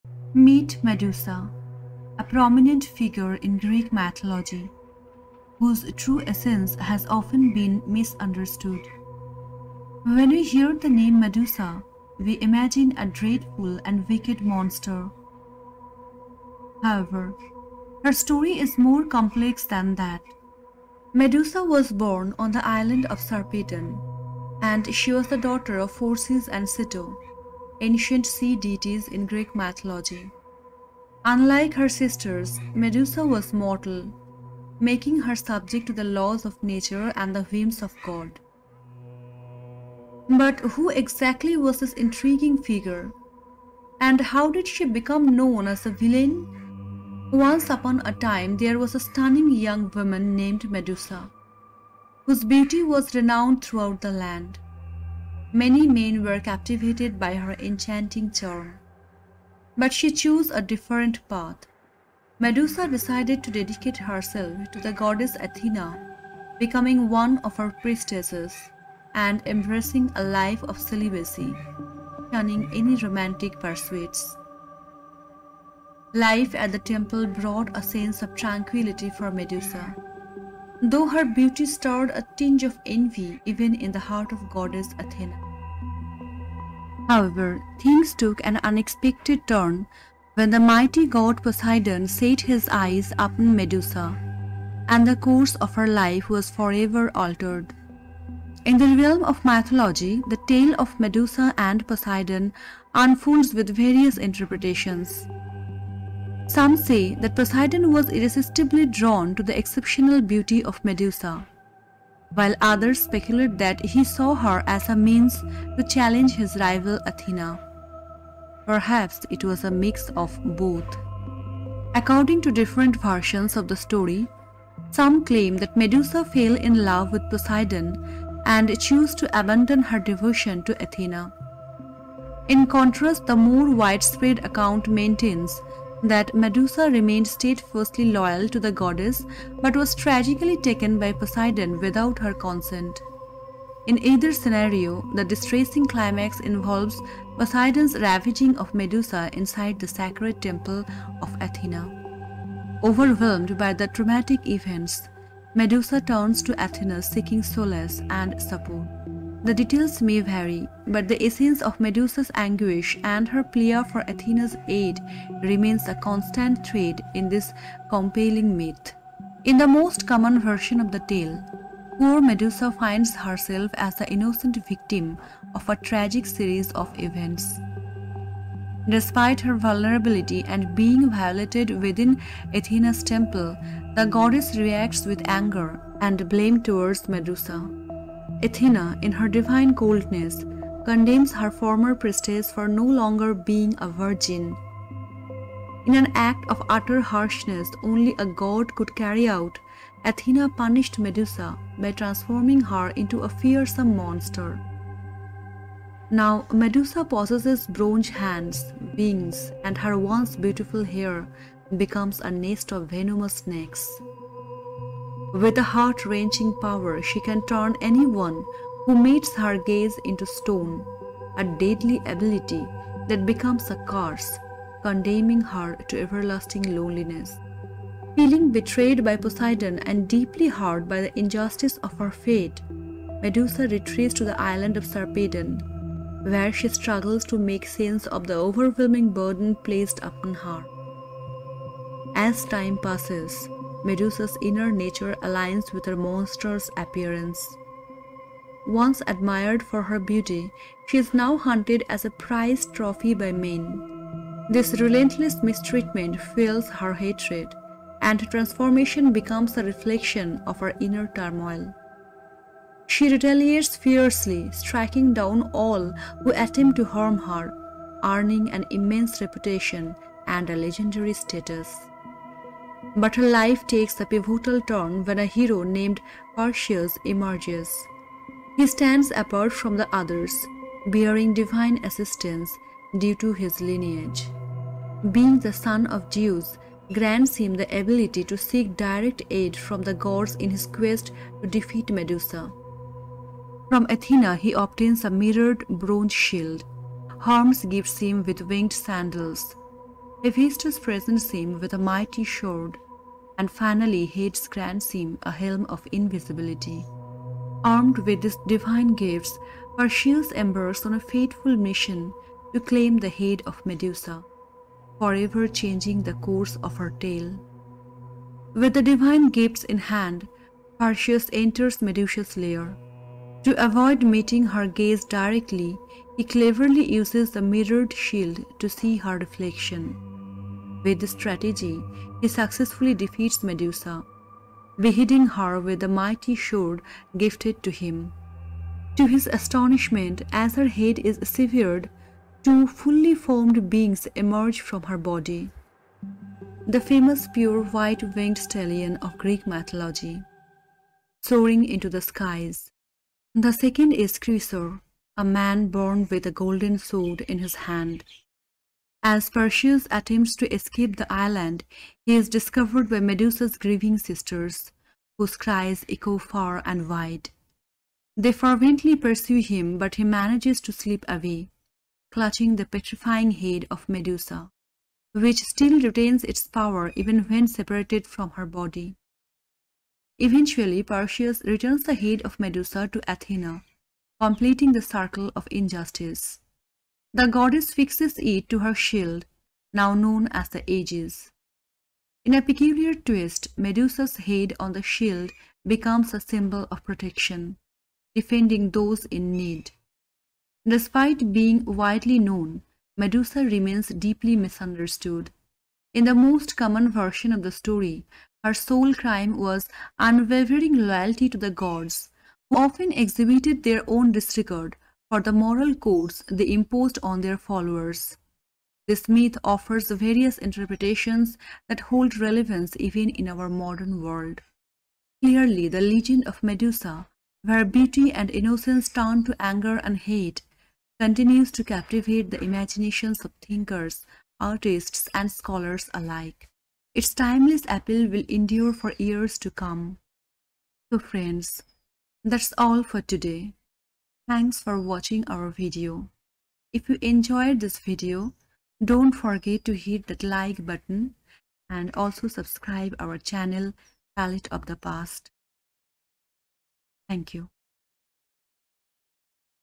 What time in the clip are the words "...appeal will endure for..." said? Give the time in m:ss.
7:17.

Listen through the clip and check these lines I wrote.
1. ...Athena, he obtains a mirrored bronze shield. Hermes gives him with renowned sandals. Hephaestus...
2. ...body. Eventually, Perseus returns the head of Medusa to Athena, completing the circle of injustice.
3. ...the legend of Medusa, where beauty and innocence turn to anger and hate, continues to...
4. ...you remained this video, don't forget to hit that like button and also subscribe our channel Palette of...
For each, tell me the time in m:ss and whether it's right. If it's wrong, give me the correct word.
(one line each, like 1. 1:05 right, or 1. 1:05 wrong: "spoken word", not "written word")
1. 4:53 wrong: "winged", not "renowned"
2. 6:18 right
3. 7:05 right
4. 7:26 wrong: "enjoyed", not "remained".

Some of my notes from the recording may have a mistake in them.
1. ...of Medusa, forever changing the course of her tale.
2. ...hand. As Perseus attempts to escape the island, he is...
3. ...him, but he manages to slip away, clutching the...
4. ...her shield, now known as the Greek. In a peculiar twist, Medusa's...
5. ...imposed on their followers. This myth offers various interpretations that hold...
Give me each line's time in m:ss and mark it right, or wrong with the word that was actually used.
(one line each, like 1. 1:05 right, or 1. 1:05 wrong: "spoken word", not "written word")
1. 5:13 right
2. 5:57 right
3. 6:09 right
4. 6:28 wrong: "Aegis", not "Greek"
5. 6:56 right.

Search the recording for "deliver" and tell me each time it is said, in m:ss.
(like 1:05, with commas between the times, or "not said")
not said.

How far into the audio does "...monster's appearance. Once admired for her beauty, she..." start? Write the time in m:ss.
4:05.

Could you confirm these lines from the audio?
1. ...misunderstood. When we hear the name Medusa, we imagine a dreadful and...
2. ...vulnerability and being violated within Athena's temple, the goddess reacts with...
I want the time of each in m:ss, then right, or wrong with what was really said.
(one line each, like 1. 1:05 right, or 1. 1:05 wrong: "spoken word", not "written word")
1. 0:07 right
2. 2:59 right.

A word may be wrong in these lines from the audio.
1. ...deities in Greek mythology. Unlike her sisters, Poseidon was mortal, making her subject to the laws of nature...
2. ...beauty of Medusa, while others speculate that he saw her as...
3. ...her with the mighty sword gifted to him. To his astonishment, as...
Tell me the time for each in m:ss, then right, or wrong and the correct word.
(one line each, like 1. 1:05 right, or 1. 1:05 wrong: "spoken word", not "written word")
1. 0:28 wrong: "Medusa", not "Poseidon"
2. 1:50 right
3. 5:35 right.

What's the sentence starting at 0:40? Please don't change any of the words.
But who exactly was this intriguing figure?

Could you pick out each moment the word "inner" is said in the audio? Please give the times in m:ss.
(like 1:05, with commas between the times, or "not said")
4:04, 4:20.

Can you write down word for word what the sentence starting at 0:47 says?
Once upon a time, there was a stunning young woman named Medusa, whose beauty was renowned throughout the land.